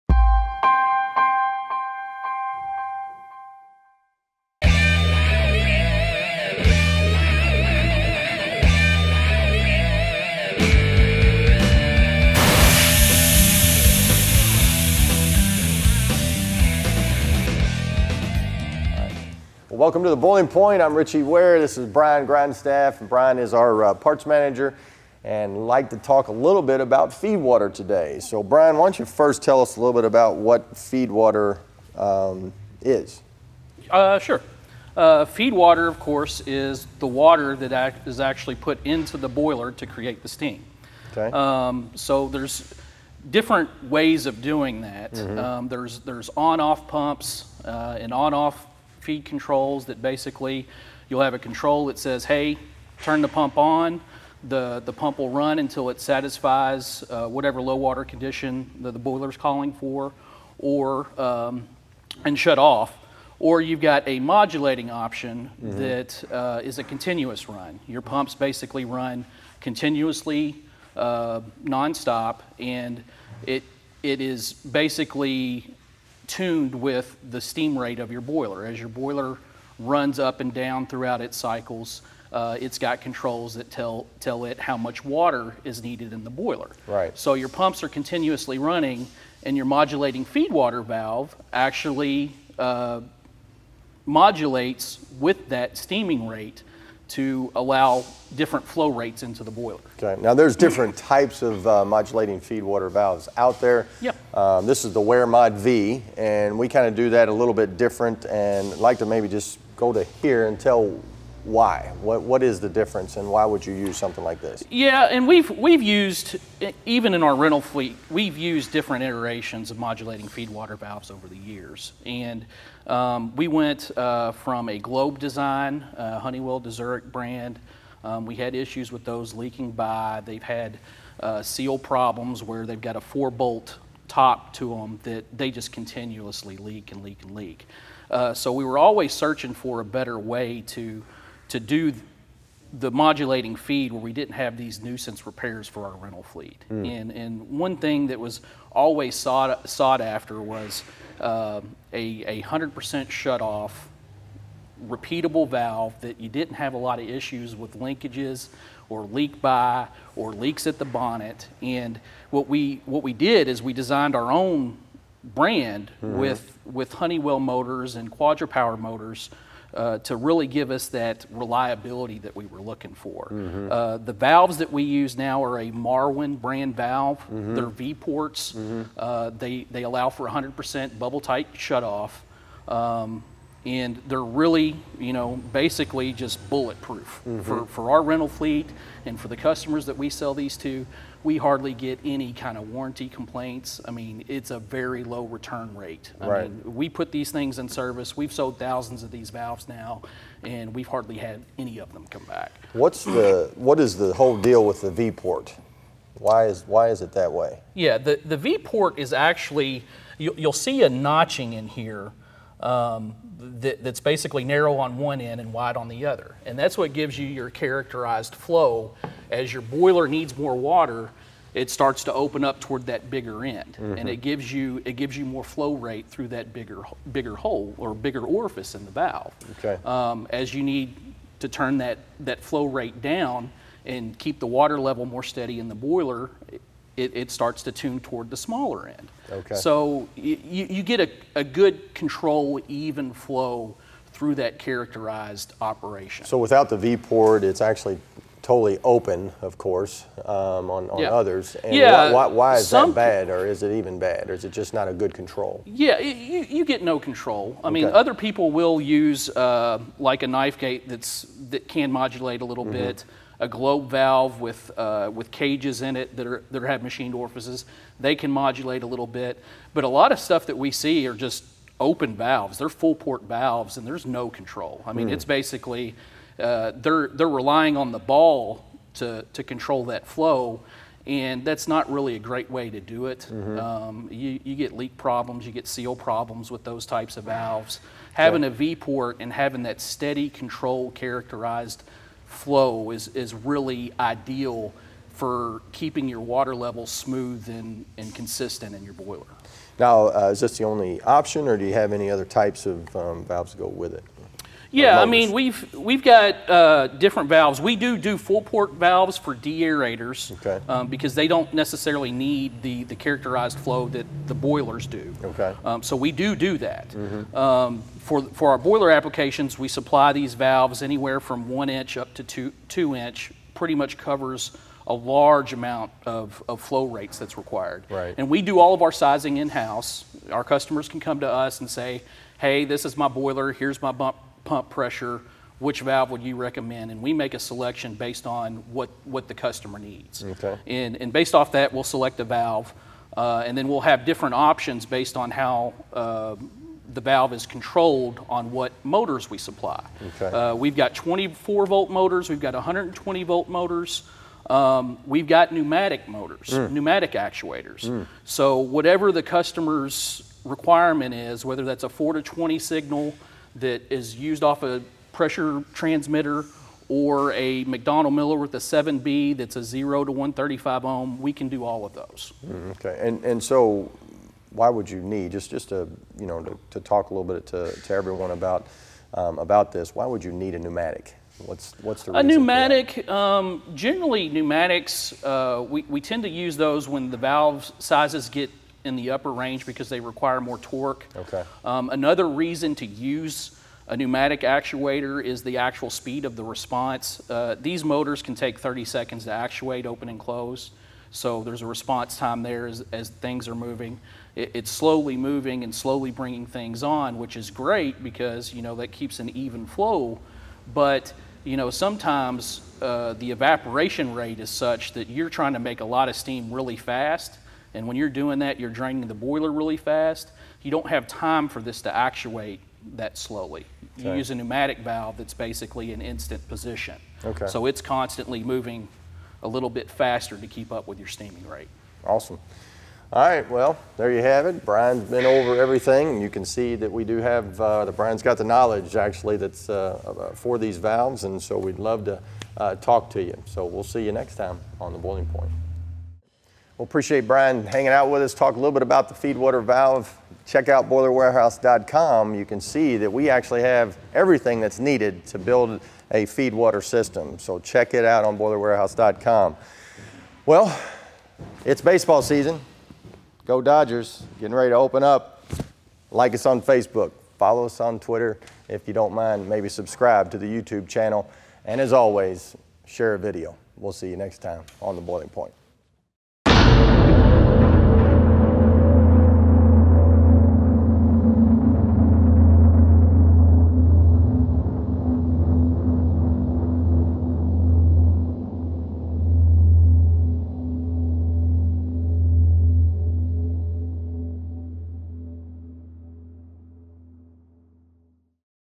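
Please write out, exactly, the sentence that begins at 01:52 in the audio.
What, what is the difference and why would you use something like this?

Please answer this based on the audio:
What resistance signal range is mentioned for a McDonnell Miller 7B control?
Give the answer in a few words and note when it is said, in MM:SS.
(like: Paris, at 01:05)
0 to 135 ohm, at 06:09.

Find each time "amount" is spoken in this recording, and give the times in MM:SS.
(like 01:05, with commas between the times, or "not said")
05:25.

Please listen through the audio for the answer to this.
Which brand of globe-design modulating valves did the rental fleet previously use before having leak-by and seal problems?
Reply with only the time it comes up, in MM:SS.
02:06.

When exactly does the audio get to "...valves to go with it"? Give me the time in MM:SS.
05:03.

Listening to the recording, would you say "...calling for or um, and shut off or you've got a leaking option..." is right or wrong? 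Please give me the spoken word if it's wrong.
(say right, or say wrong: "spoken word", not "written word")
wrong: "modulating", not "leaking".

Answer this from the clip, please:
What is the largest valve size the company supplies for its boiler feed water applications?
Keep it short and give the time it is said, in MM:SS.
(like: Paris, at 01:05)
2 inch, at 05:22.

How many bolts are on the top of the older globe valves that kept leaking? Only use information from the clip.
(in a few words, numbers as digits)
4.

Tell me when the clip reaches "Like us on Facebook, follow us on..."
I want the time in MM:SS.
07:46.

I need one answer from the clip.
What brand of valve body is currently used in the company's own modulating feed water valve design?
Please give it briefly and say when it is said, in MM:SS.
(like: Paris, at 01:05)
Marwin, at 02:55.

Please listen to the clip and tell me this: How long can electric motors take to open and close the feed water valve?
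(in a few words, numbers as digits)
30 seconds.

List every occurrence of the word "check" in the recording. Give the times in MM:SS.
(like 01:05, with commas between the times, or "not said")
07:30, 07:37.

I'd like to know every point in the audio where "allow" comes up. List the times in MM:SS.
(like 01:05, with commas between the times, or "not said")
01:37, 02:59.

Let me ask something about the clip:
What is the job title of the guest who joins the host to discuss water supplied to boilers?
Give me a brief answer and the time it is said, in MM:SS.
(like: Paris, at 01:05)
Parts manager, at 00:23.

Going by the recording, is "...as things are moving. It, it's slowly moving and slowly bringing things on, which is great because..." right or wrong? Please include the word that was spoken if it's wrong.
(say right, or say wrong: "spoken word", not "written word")
right.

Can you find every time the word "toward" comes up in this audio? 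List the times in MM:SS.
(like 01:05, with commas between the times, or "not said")
03:42, 03:57.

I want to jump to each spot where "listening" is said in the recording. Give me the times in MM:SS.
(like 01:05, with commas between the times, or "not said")
not said.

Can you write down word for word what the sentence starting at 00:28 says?
So Brian, why don't you first tell us a little bit about what feed water um, is?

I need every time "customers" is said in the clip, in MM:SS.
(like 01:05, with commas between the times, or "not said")
03:09, 05:30, 05:39, 05:59.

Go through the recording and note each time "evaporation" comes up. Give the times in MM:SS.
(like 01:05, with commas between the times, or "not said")
06:53.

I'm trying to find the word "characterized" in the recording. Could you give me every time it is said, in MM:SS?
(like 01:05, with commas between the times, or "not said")
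03:37, 04:04, 04:50, 05:12.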